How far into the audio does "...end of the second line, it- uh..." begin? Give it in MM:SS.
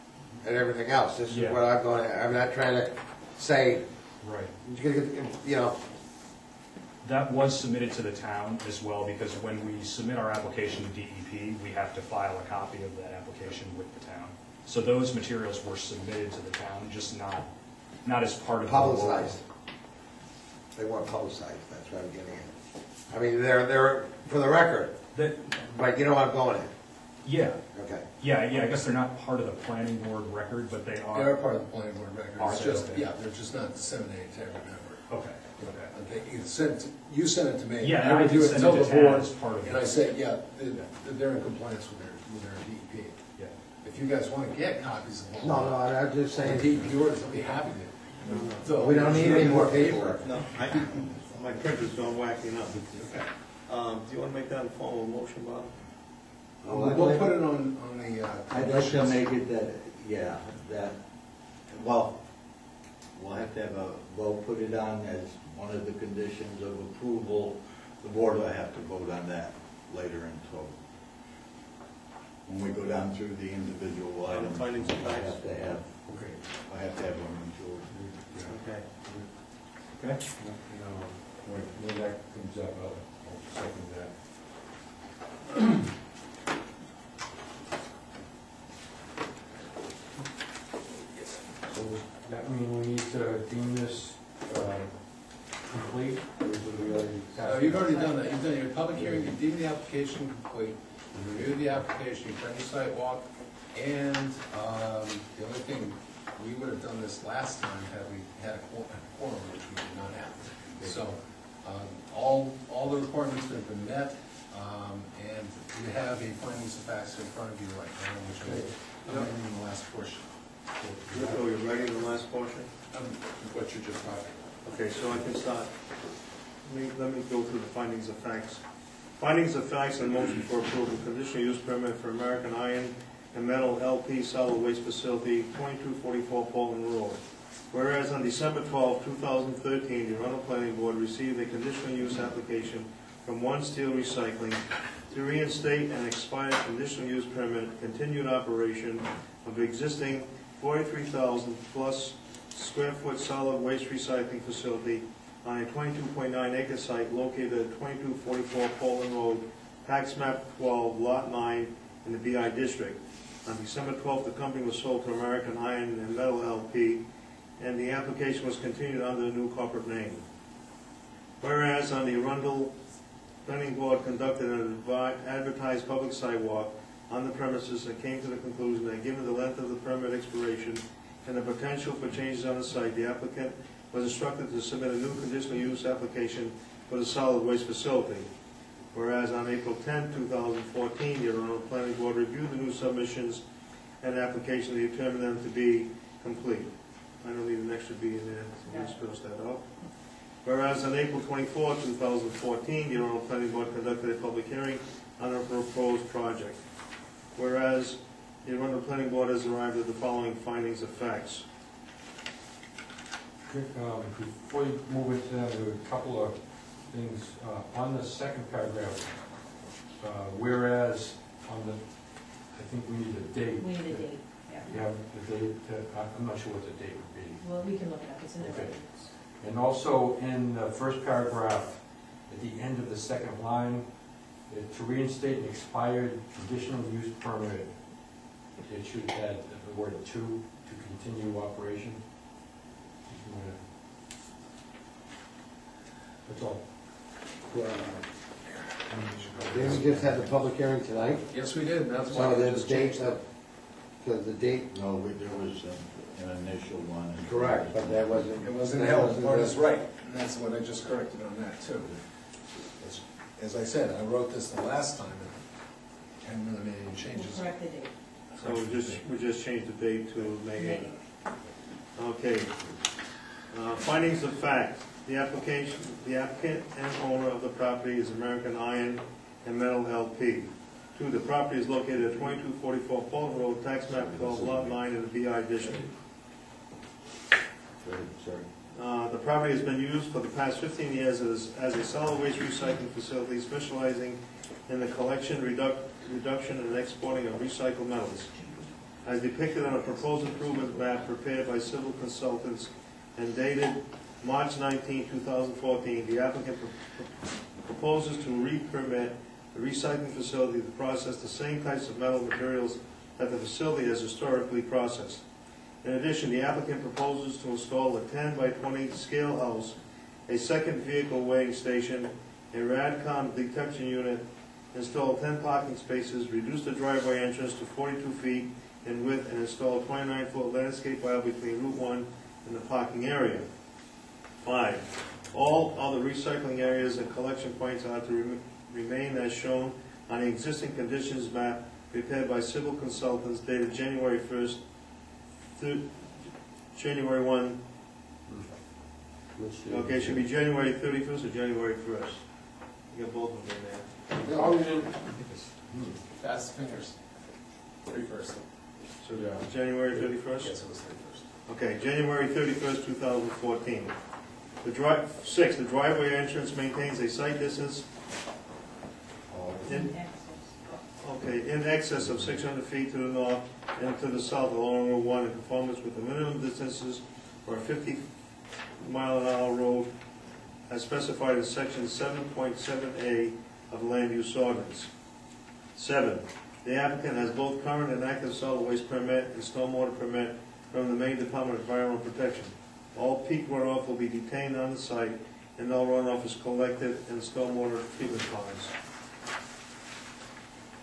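03:52.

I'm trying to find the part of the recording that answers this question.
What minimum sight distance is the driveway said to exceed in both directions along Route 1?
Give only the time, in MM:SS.
06:12.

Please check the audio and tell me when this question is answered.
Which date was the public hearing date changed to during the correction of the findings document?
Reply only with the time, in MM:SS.
04:30.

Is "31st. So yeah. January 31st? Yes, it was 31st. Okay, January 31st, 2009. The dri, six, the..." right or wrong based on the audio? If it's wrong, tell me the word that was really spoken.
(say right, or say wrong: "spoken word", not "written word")
wrong: "2014", not "2009".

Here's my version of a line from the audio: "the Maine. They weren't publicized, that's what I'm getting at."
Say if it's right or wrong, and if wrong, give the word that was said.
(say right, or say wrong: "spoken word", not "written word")
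wrong: "Publicized", not "Maine".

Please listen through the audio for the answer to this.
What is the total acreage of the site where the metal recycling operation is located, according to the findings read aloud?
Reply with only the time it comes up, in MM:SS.
02:35.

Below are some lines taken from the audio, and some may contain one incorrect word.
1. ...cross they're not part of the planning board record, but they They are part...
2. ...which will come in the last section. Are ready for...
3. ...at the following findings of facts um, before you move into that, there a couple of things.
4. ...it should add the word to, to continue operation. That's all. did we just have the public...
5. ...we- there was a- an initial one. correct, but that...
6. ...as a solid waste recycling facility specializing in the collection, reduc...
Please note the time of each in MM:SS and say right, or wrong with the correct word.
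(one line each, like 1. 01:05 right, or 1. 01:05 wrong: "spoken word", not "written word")
1. 00:28 wrong: "guess", not "cross"
2. 01:58 wrong: "portion", not "section"
3. 03:29 right
4. 03:58 right
5. 04:14 right
6. 04:51 right.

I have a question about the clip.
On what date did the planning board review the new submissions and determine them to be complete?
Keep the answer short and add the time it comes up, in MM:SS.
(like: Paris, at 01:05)
April 10, 2014, at 03:09.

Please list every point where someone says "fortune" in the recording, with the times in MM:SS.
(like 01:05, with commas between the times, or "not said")
not said.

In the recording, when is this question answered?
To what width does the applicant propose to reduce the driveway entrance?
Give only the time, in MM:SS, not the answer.
05:27.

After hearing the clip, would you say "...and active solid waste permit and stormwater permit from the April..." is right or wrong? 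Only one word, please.
wrong.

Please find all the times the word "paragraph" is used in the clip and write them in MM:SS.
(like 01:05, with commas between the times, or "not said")
03:38, 03:51.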